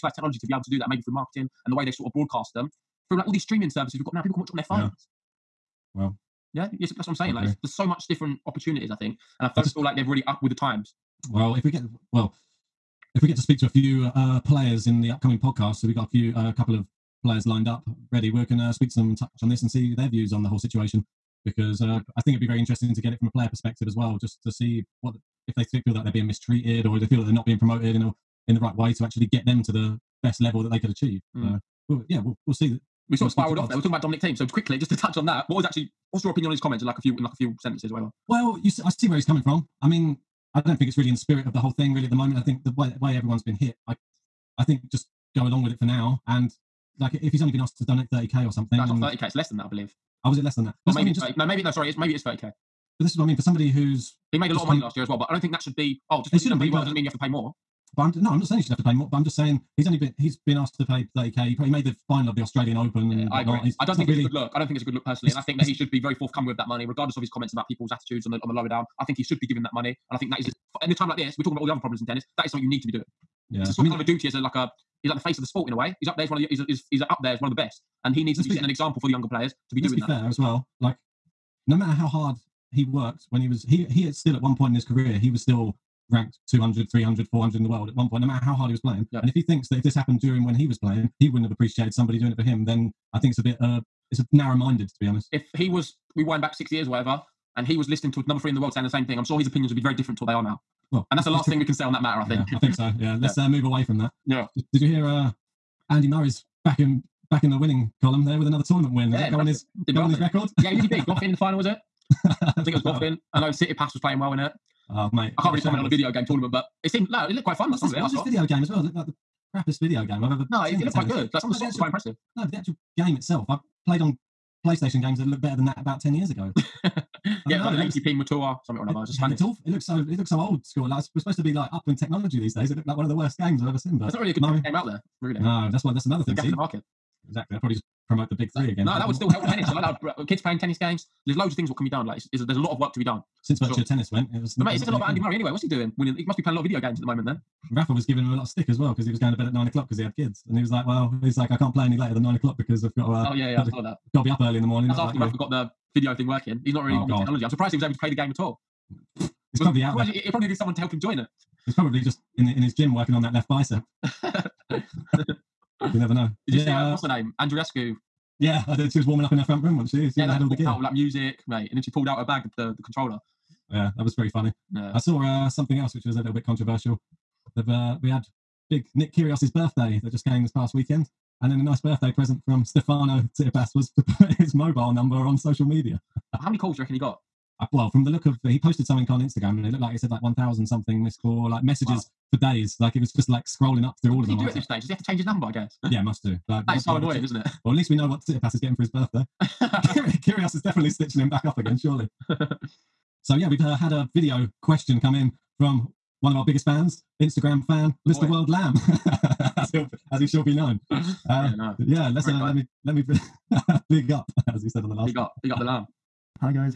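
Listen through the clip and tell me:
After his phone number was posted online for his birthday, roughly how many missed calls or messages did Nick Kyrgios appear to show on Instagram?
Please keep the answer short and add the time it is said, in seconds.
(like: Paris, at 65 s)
1,000, at 190 s.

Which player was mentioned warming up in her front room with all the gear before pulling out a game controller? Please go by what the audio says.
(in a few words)
Andreescu.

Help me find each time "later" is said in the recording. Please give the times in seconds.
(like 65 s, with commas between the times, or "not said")
151 s.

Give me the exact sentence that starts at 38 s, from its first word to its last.
Well, you see, I see where he's coming from.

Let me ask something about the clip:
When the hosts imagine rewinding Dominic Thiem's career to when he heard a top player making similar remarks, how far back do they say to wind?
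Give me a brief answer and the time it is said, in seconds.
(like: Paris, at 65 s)
6 years, at 96 s.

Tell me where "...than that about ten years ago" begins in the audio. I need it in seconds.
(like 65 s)
125 s.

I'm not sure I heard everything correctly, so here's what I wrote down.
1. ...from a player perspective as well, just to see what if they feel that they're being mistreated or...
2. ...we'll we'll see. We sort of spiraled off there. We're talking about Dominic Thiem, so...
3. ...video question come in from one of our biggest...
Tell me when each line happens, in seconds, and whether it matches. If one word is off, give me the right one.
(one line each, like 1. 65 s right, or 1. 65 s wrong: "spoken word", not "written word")
1. 23 s right
2. 32 s right
3. 204 s right.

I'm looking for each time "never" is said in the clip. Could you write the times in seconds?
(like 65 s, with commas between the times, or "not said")
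165 s.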